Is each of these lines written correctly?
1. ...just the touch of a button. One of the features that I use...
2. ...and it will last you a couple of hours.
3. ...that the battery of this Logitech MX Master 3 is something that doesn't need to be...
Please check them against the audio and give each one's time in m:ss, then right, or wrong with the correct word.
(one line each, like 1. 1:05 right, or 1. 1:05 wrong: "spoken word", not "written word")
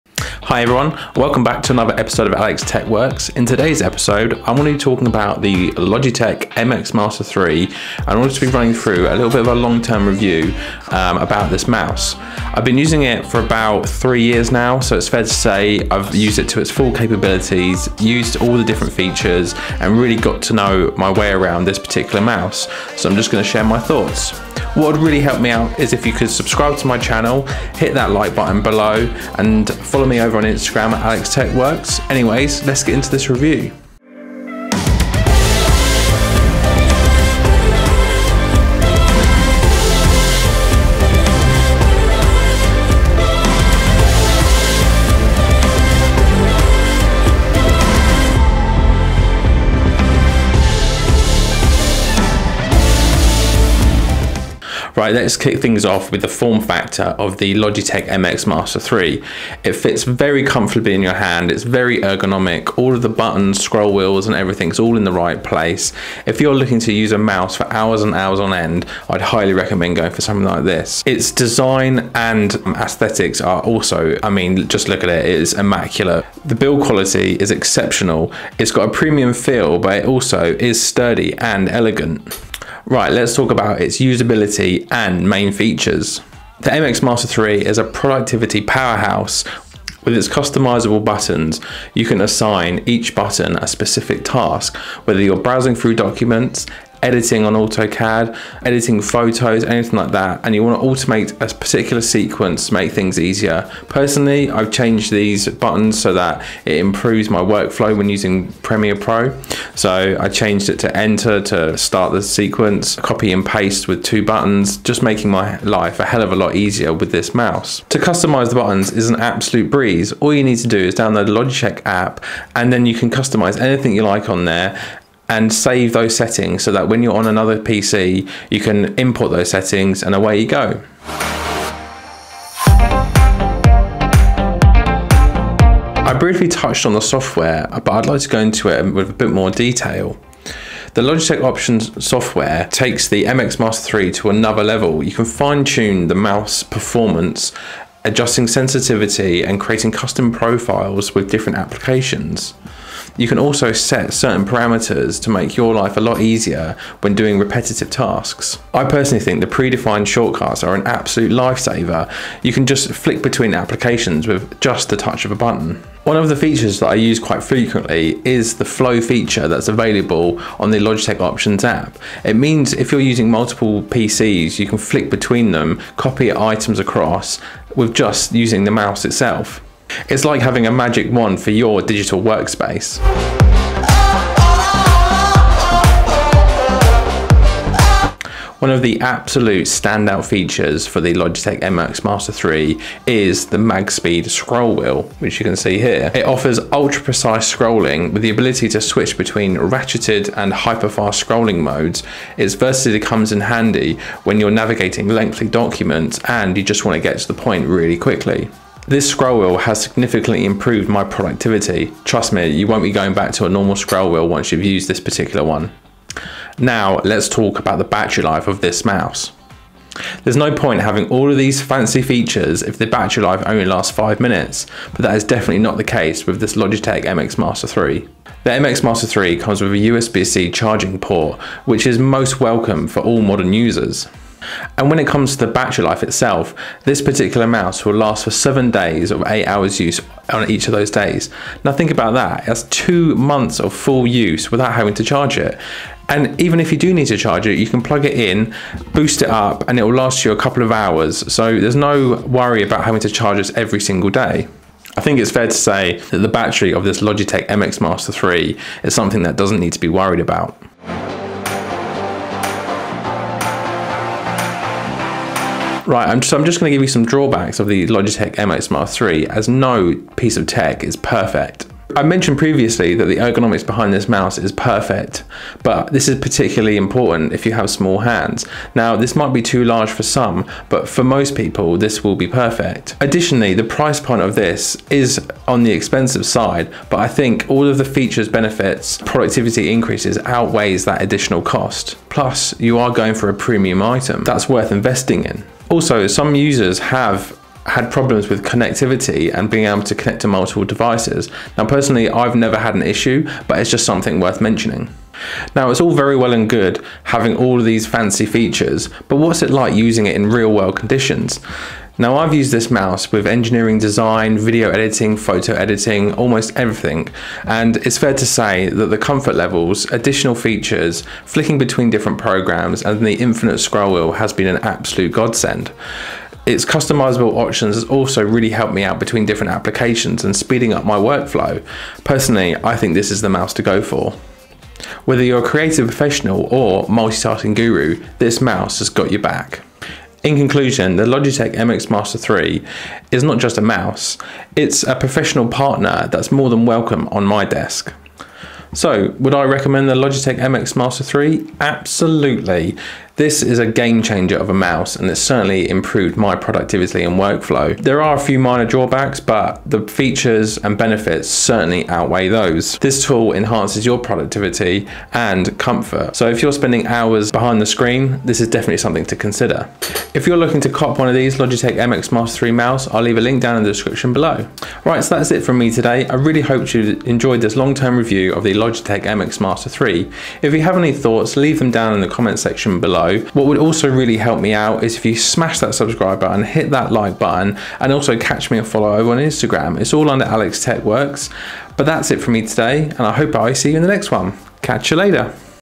1. 2:44 right
2. 4:09 right
3. 4:16 right.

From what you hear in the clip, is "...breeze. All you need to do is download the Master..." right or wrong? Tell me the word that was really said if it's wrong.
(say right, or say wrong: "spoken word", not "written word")
wrong: "Logitech", not "Master".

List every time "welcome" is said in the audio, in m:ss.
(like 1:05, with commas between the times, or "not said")
0:01, 3:52, 5:46.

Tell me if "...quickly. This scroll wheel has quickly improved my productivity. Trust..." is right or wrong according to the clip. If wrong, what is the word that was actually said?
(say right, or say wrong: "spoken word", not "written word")
wrong: "significantly", not "quickly".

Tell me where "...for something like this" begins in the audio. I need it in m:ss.
1:10.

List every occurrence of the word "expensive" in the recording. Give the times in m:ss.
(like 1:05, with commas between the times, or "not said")
4:45.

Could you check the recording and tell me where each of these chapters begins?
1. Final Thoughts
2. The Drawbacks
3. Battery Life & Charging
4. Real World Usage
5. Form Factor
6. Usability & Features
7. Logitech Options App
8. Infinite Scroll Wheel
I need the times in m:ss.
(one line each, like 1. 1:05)
1. 5:42
2. 4:28
3. 3:39
4. 5:08
5. 0:57
6. 1:24
7. 2:18
8. 3:12.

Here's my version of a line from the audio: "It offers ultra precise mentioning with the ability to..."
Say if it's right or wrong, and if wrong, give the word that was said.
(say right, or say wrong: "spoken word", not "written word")
wrong: "scrolling", not "mentioning".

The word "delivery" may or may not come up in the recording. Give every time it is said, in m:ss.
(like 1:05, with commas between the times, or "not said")
not said.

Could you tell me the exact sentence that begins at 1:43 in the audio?
Personally, I've changed these buttons so that it improves my workflow when using Premiere Pro.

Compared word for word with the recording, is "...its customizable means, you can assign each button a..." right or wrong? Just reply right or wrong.
wrong.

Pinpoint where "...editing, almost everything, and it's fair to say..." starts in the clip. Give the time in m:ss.
5:15.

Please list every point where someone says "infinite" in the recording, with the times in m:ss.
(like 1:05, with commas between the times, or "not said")
5:23.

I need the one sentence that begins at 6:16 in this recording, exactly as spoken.
I really hope you enjoyed this long-term review of the Logitech MX Master 3.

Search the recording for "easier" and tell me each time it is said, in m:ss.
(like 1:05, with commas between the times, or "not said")
1:43, 1:56, 2:36.